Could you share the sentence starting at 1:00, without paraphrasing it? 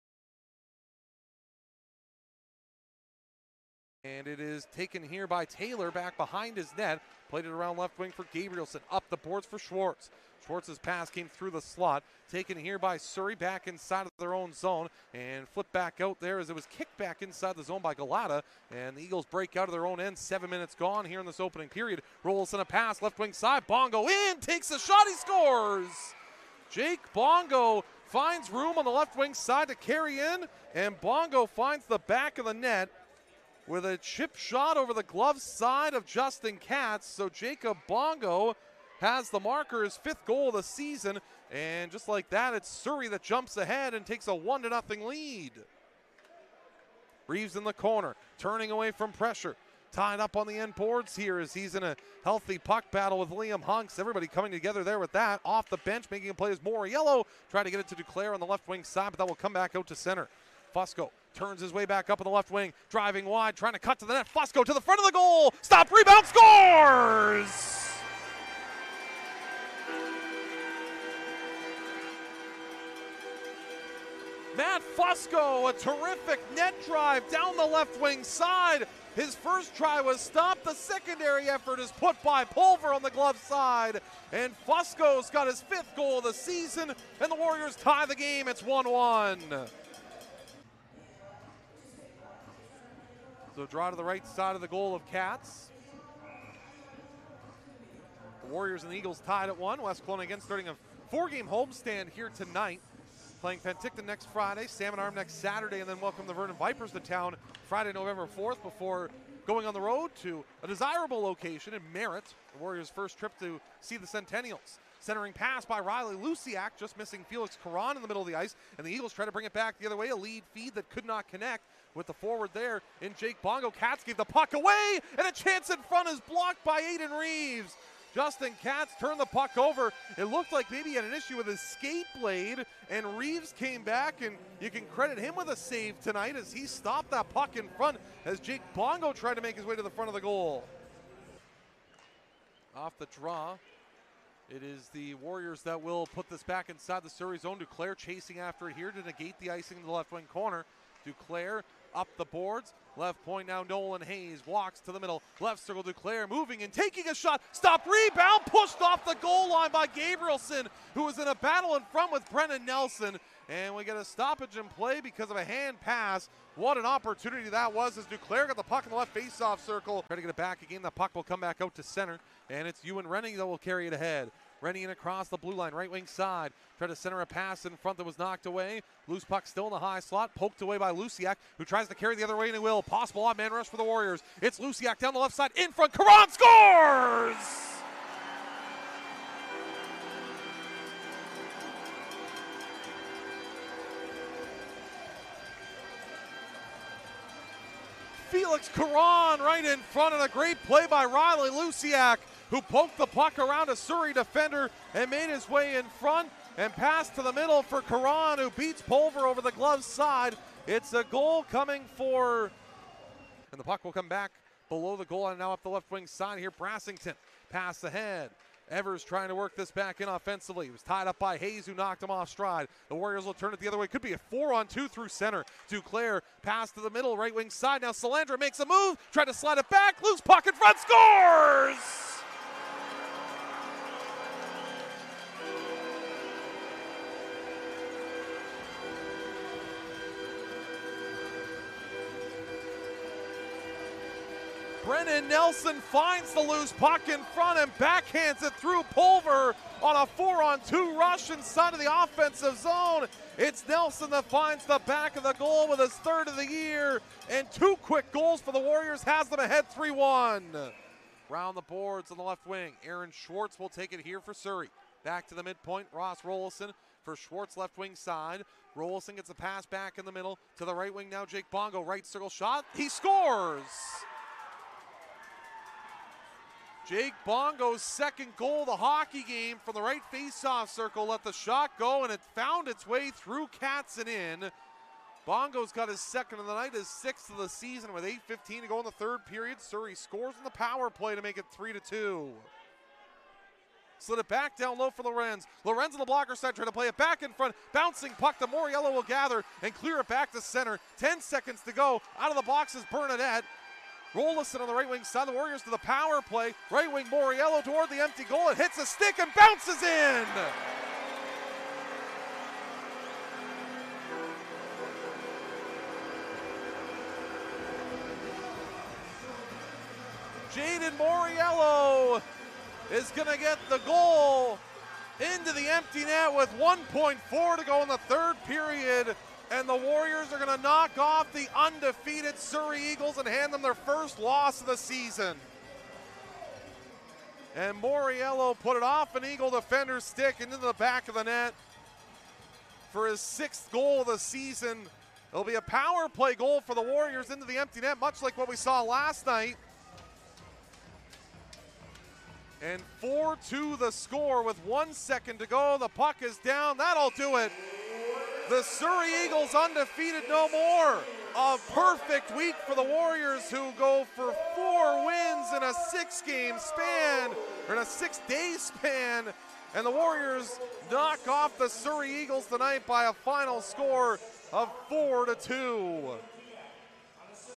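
Fusco turns his way back up in the left wing, driving wide, trying to cut to the net.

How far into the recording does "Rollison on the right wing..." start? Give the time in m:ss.
5:04.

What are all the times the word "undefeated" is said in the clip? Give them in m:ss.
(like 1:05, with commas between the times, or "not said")
5:31, 5:59.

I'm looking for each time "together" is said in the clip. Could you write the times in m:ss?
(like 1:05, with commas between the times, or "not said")
0:54.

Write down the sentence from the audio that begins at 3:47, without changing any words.
Now Solandra makes a move, tried to slide it back.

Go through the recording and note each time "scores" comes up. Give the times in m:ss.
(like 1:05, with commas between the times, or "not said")
0:25, 1:06, 3:06, 3:50, 4:32, 4:49, 5:53, 6:13.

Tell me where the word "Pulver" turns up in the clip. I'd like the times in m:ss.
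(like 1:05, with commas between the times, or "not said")
1:22, 3:28, 4:08.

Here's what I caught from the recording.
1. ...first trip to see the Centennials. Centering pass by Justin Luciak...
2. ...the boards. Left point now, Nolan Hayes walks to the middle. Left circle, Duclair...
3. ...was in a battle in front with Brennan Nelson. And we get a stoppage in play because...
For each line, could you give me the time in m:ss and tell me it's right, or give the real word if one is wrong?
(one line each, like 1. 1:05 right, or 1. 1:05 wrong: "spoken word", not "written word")
1. 1:52 wrong: "Riley", not "Justin"
2. 2:32 right
3. 2:41 right.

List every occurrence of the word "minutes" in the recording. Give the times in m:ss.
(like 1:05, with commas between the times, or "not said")
0:20.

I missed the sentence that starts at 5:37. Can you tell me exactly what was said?
And Moriello put it off an Eagle defender's stick into the back of the net for his sixth goal of the season.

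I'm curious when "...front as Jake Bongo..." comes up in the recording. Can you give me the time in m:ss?
2:17.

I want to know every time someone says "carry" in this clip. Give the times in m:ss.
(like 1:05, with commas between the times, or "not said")
0:29, 2:53, 3:01.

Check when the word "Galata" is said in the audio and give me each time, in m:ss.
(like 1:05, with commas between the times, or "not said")
0:17.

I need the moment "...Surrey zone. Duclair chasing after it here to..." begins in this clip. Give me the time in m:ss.
2:27.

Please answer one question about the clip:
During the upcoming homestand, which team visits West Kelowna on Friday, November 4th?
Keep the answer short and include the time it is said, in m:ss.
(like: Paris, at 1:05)
Vernon Vipers, at 1:46.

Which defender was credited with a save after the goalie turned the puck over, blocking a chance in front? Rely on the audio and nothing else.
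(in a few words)
Aiden Reeves.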